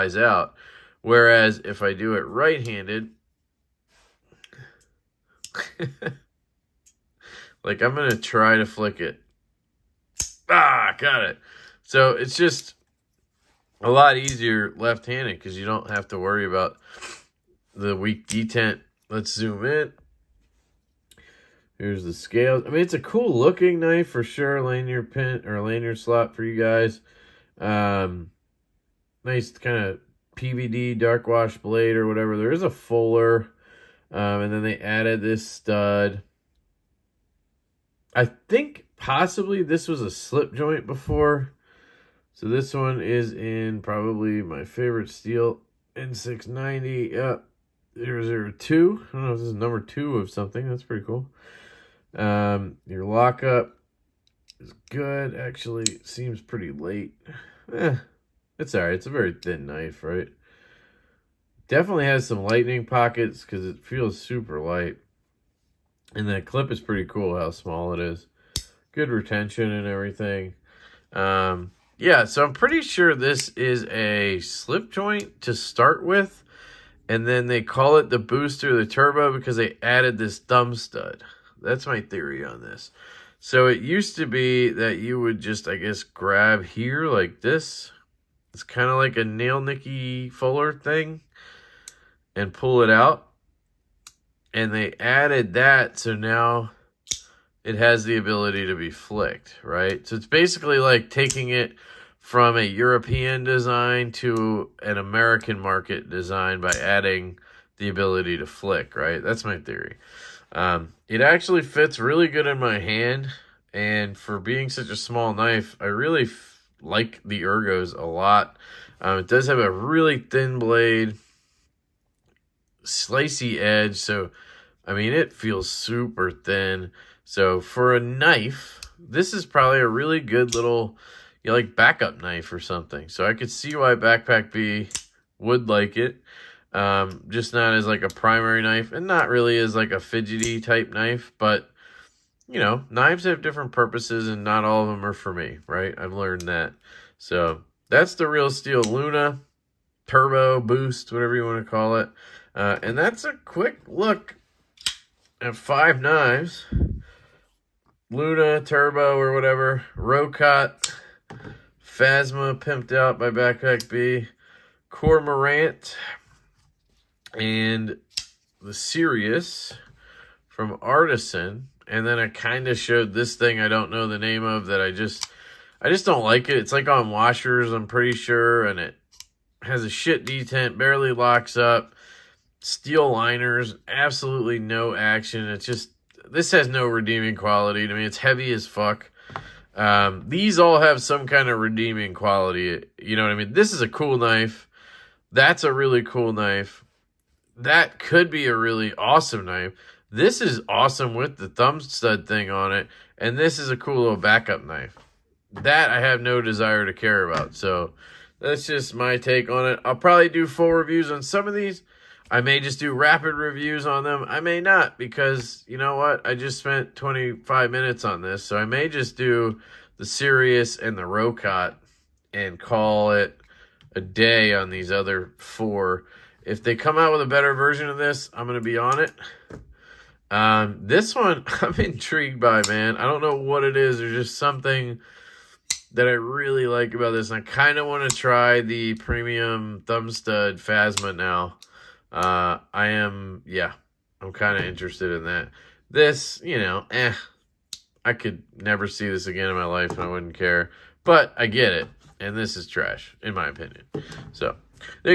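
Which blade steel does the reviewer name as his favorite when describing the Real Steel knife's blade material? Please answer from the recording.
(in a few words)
N690.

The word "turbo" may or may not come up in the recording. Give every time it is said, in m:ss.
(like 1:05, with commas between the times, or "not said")
1:18, 2:30, 2:38.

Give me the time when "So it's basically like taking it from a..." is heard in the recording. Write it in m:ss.
1:40.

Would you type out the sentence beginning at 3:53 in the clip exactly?
There's just something that I really like about this.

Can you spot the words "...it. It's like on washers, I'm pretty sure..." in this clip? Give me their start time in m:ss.
2:56.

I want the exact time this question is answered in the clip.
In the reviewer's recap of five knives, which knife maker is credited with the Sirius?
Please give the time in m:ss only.
2:50.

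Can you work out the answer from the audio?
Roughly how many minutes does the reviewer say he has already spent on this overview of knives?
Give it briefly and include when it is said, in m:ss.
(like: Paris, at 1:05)
25, at 3:36.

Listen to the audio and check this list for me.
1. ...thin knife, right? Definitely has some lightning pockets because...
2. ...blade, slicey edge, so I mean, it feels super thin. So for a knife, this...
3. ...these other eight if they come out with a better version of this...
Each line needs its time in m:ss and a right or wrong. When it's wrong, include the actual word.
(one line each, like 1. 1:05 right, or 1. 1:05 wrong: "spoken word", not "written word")
1. 0:59 right
2. 2:00 right
3. 3:44 wrong: "four", not "eight".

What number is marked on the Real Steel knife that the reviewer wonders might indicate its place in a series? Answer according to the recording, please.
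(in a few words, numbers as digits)
002.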